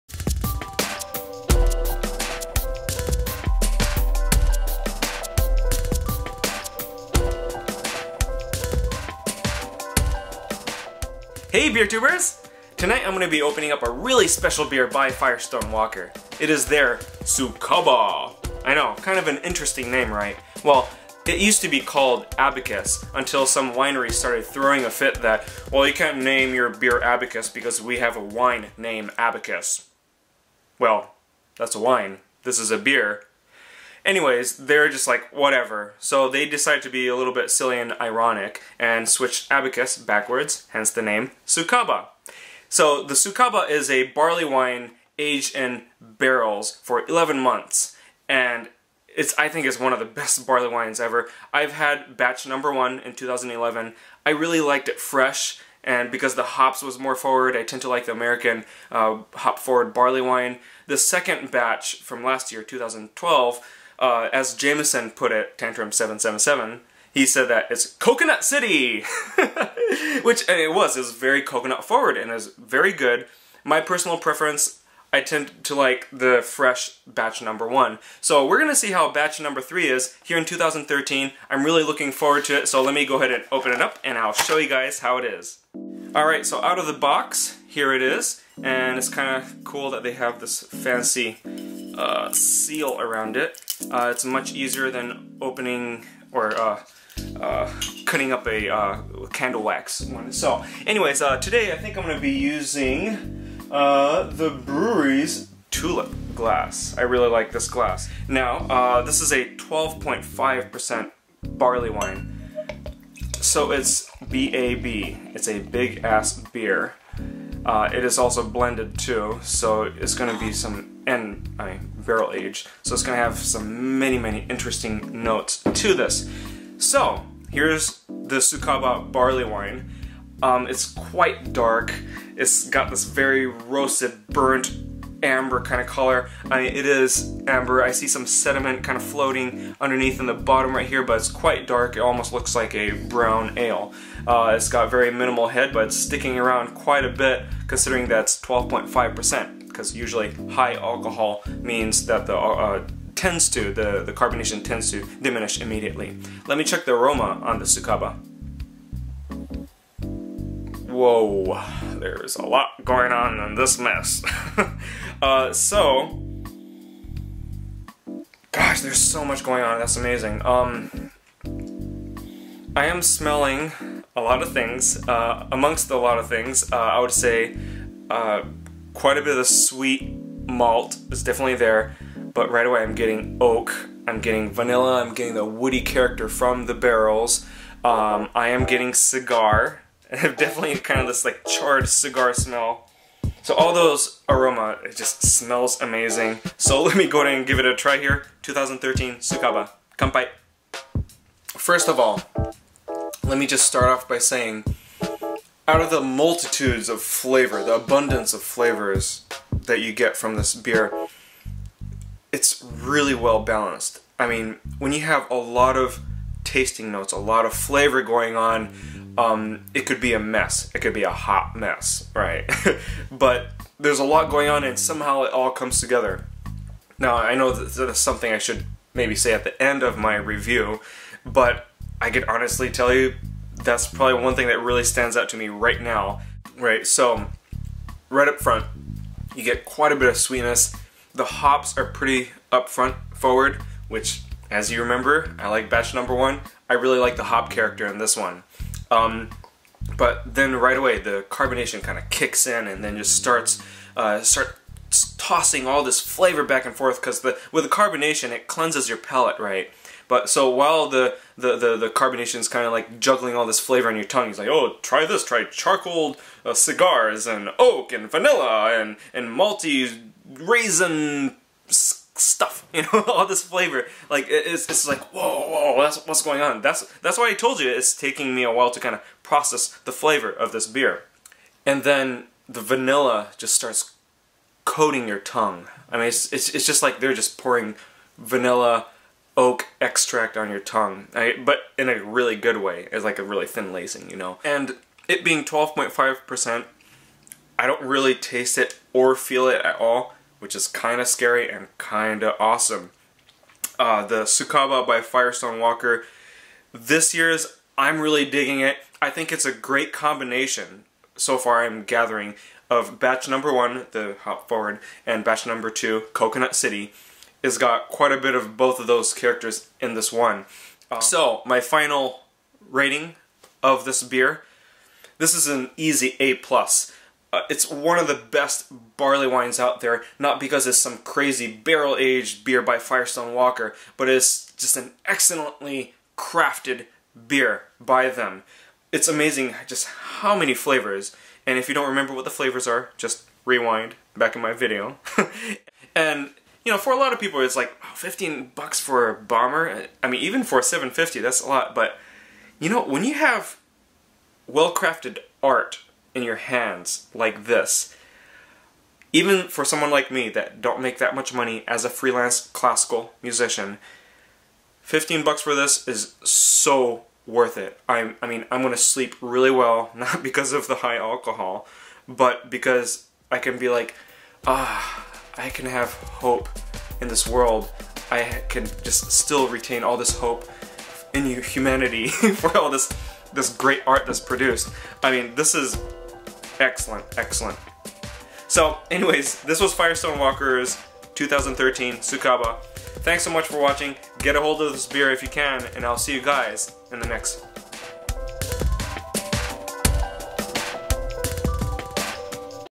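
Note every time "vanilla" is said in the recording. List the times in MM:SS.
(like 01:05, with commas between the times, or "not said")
03:04, 04:28, 04:42, 04:48.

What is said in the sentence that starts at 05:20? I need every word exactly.
Um, so, my final rating of this beer, this is an easy A+.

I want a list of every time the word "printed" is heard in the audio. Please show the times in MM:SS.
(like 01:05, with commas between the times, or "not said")
not said.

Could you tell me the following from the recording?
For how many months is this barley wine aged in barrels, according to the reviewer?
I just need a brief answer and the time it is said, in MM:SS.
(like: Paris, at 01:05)
11, at 00:47.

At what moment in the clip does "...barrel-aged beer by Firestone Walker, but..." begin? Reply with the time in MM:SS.
05:31.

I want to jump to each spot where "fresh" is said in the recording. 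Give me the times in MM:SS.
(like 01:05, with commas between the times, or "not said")
00:55, 01:16.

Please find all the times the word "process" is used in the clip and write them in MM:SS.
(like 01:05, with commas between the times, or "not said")
04:39.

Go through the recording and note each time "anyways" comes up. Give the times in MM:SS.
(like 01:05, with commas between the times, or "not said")
00:34, 01:40, 06:28.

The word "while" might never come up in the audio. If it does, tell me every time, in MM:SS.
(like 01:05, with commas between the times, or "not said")
04:20, 04:38.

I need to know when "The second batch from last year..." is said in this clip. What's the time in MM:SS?
01:00.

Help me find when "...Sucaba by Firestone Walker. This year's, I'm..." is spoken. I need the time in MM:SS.
05:04.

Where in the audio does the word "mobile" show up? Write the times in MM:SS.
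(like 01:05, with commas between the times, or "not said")
not said.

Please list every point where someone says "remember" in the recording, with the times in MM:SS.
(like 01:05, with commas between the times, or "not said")
04:04, 05:41.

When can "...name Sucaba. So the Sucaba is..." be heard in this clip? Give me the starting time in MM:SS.
00:41.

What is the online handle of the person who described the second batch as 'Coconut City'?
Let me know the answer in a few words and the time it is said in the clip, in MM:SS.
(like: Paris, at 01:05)
Tantrum777, at 01:05.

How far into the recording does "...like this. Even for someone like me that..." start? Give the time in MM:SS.
05:57.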